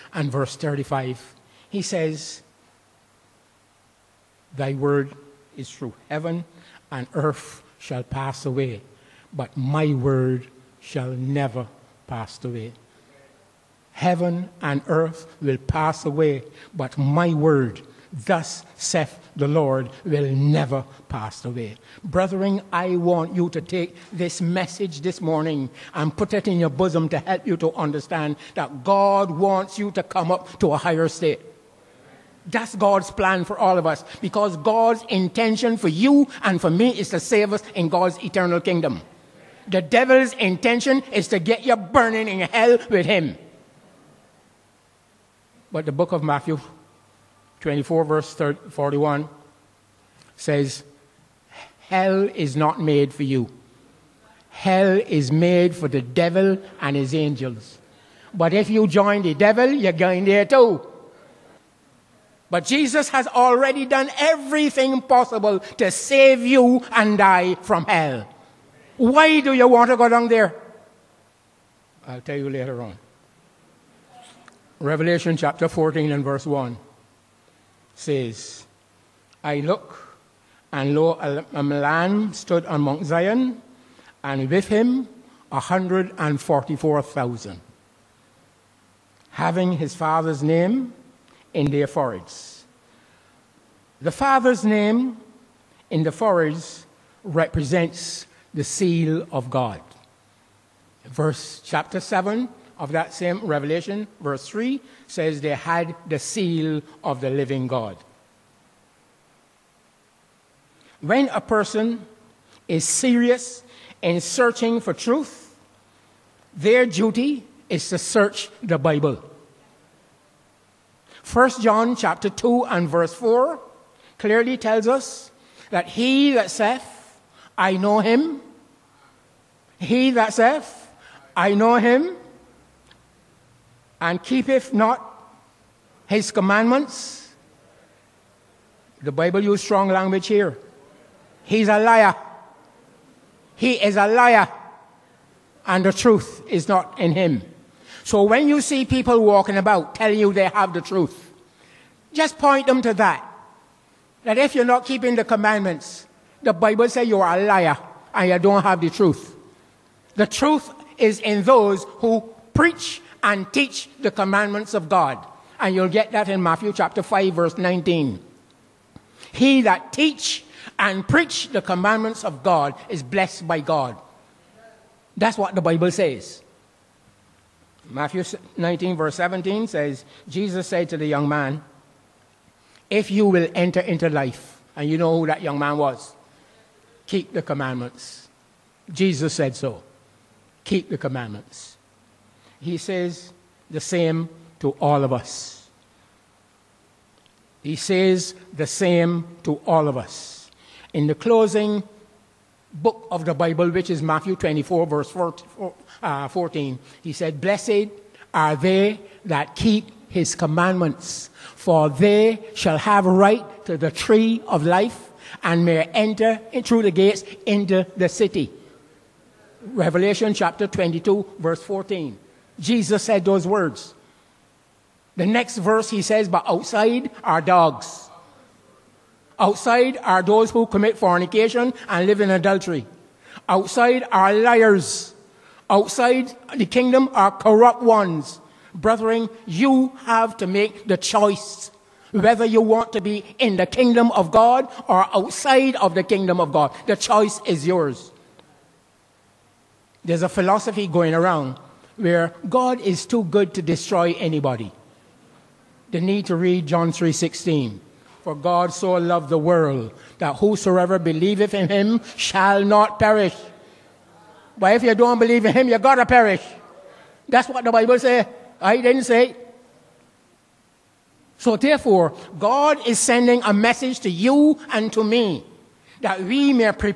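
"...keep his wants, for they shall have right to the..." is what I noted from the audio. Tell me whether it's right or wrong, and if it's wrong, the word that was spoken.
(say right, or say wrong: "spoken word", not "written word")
wrong: "commandments", not "wants".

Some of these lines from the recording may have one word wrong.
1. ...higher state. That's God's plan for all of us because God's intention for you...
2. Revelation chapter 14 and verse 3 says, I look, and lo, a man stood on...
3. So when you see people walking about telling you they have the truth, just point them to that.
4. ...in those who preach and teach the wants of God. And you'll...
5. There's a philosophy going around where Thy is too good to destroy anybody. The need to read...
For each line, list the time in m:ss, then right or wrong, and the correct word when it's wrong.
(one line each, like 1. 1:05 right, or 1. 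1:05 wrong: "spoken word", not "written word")
1. 0:30 right
2. 1:14 wrong: "1", not "3"
3. 2:28 right
4. 2:41 wrong: "commandments", not "wants"
5. 4:10 wrong: "God", not "Thy".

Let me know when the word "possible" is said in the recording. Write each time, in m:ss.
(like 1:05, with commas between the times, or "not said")
1:05.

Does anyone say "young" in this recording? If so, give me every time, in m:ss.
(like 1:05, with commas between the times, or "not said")
3:01, 3:05.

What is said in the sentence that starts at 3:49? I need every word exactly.
Outside are those who commit fornication and live in adultery.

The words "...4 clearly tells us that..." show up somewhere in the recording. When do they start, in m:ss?
2:03.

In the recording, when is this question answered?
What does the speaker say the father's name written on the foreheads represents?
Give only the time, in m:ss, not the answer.
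1:38.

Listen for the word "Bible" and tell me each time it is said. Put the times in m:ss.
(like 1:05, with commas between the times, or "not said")
1:58, 2:19, 2:36, 2:55, 3:23, 4:27.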